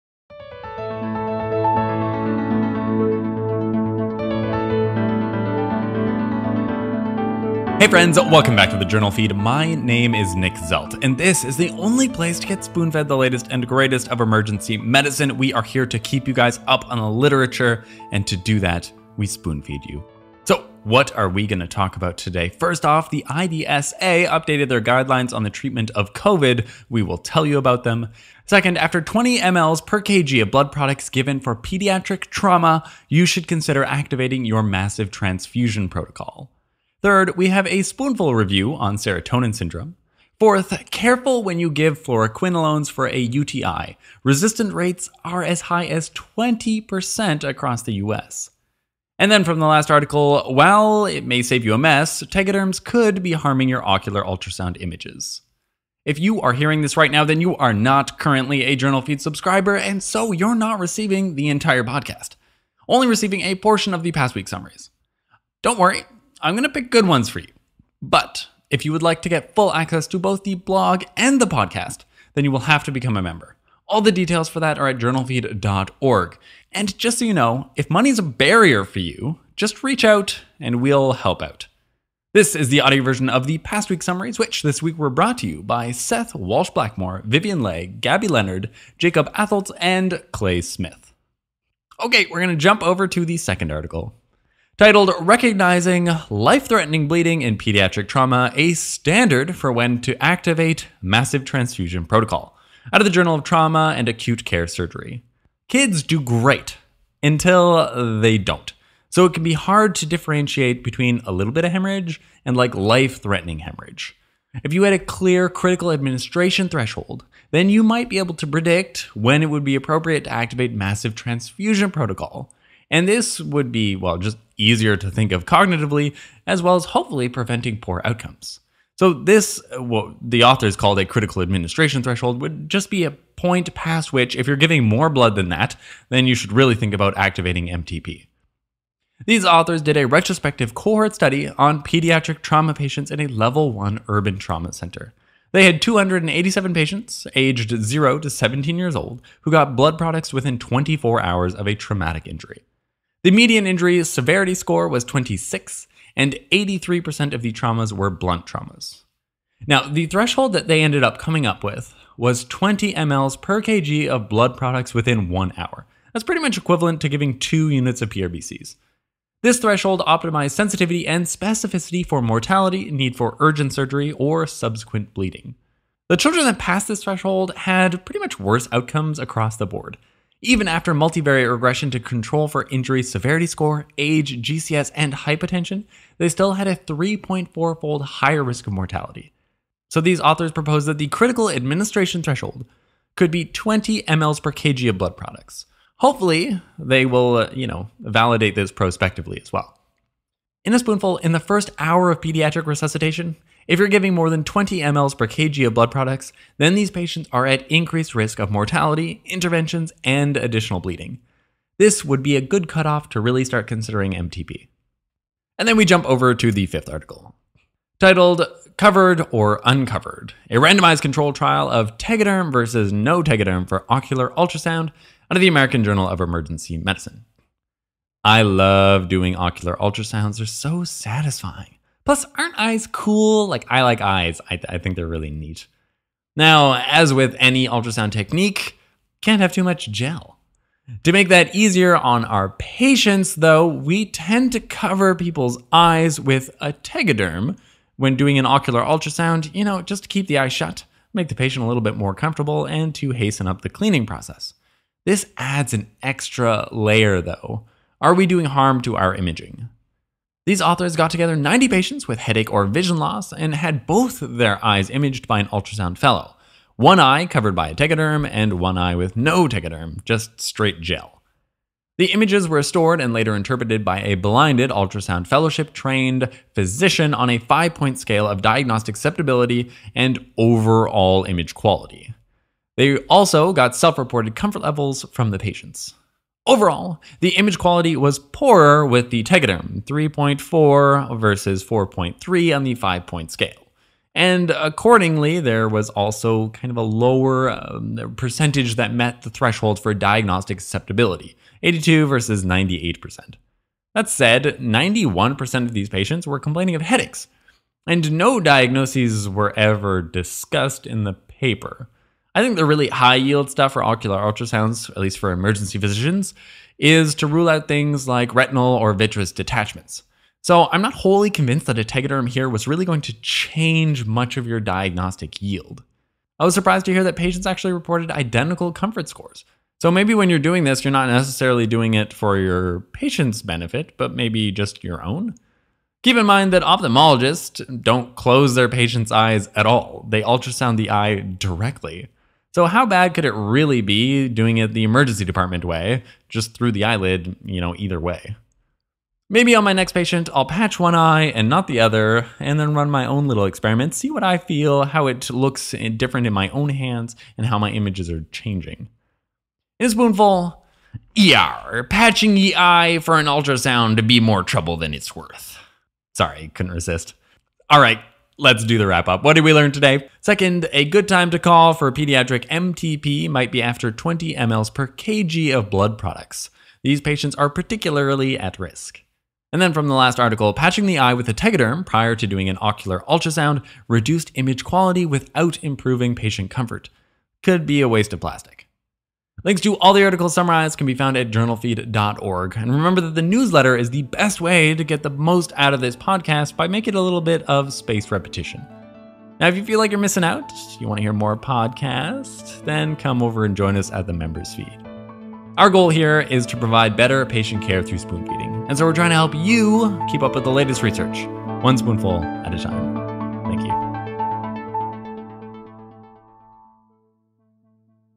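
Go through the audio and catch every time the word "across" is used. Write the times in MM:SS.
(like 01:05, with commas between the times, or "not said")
00:47, 02:59.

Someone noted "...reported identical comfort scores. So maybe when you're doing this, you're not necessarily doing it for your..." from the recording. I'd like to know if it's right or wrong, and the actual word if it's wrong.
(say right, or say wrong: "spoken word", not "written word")
right.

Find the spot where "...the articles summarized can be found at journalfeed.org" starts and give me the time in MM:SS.
06:29.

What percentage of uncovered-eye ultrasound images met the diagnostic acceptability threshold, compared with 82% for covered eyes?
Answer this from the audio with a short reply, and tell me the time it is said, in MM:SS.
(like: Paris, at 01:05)
98%, at 05:02.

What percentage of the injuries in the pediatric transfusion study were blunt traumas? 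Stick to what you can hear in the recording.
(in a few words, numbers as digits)
83%.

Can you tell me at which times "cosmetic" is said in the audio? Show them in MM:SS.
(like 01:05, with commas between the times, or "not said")
not said.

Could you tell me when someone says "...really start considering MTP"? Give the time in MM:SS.
03:33.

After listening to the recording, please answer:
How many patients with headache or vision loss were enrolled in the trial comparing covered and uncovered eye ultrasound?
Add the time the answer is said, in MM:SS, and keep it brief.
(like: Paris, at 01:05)
90, at 04:21.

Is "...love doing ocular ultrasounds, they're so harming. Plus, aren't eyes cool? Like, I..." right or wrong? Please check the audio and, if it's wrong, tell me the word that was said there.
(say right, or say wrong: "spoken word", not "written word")
wrong: "satisfying", not "harming".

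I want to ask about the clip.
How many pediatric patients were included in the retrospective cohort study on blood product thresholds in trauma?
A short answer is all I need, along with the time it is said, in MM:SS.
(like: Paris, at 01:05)
287, at 02:25.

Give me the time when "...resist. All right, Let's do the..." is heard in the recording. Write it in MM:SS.
06:06.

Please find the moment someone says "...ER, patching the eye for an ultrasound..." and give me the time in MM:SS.
06:01.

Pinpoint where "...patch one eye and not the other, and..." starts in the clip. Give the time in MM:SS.
05:50.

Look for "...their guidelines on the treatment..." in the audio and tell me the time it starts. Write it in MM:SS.
00:24.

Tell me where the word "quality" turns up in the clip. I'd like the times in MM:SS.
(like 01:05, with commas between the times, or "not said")
04:41, 04:47, 06:24.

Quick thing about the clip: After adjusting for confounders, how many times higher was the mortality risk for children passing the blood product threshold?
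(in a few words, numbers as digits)
3.4 fold.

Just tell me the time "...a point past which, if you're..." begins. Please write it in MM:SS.
02:13.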